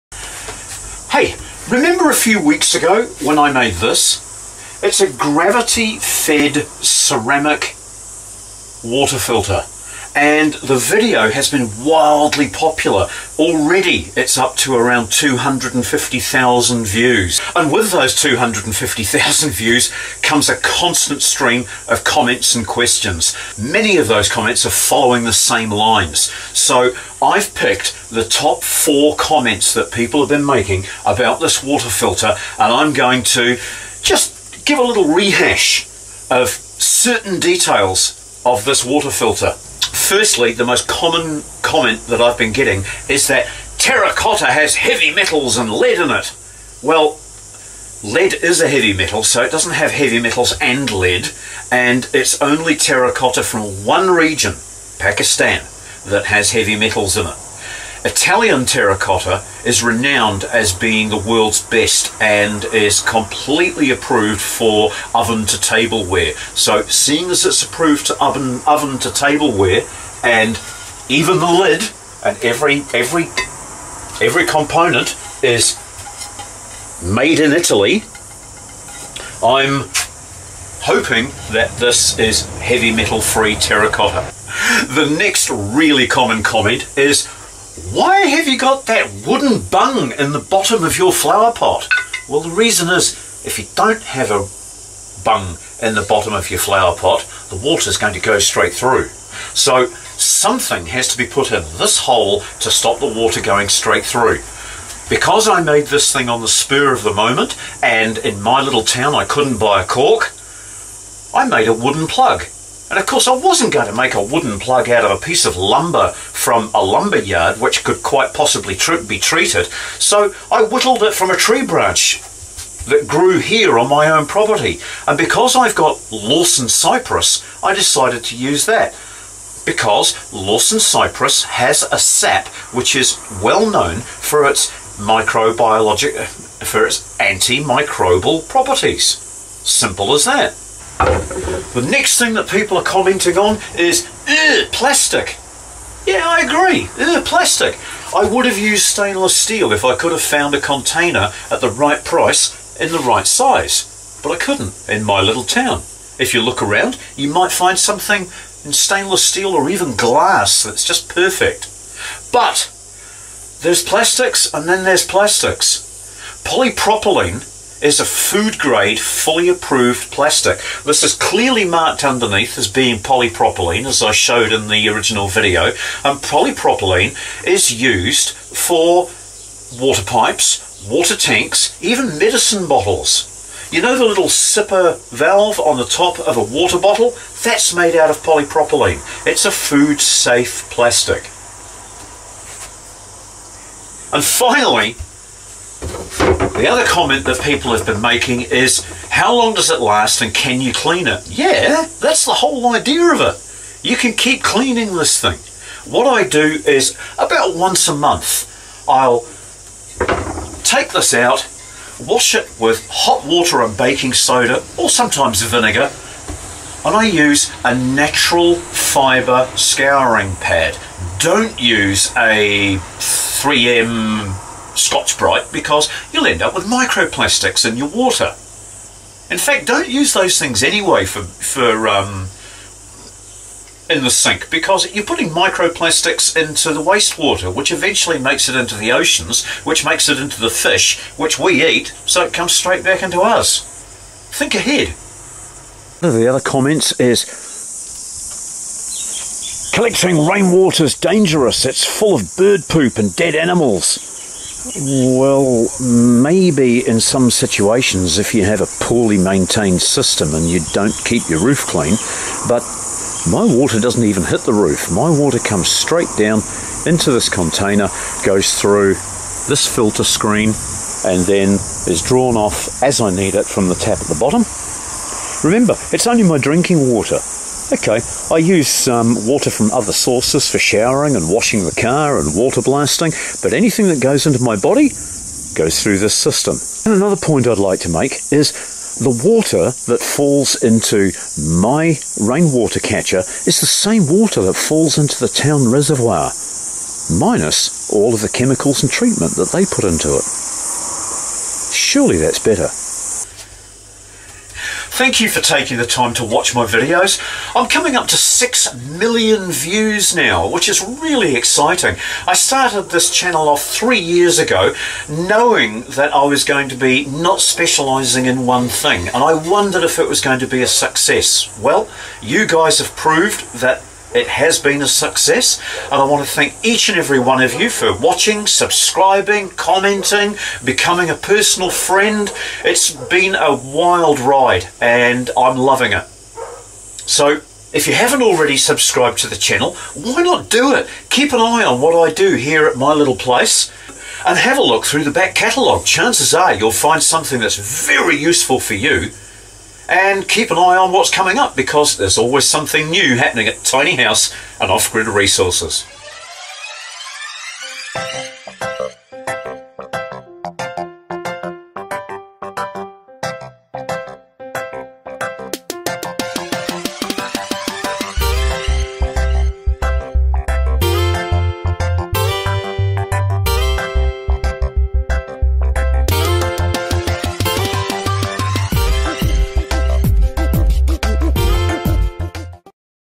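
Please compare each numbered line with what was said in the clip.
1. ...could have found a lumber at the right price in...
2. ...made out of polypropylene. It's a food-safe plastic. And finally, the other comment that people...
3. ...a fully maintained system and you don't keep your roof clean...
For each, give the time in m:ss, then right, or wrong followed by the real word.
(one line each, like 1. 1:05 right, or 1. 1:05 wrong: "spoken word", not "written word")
1. 2:29 wrong: "container", not "lumber"
2. 3:07 right
3. 4:18 wrong: "poorly", not "fully".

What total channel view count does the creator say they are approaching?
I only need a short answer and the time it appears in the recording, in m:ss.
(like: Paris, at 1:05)
6 million, at 5:08.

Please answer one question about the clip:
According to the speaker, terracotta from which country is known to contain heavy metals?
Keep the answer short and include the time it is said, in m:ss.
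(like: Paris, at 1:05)
Pakistan, at 0:54.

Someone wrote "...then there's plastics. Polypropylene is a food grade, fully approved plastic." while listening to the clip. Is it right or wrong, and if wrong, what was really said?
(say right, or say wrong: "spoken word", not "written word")
right.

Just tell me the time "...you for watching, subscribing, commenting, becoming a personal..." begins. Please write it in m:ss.
5:27.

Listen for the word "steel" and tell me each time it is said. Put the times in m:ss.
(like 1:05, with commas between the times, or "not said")
2:29, 2:39.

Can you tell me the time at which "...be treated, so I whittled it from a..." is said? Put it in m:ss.
1:59.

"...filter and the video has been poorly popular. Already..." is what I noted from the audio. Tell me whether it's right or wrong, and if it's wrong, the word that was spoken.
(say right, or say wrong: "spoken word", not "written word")
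wrong: "wildly", not "poorly".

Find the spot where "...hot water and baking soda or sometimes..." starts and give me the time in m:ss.
3:32.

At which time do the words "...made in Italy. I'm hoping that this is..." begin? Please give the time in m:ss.
1:17.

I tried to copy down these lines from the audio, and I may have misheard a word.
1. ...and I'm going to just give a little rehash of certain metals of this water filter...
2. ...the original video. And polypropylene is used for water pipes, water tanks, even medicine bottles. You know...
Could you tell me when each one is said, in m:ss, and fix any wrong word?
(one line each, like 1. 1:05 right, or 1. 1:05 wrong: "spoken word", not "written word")
1. 0:32 wrong: "details", not "metals"
2. 2:54 right.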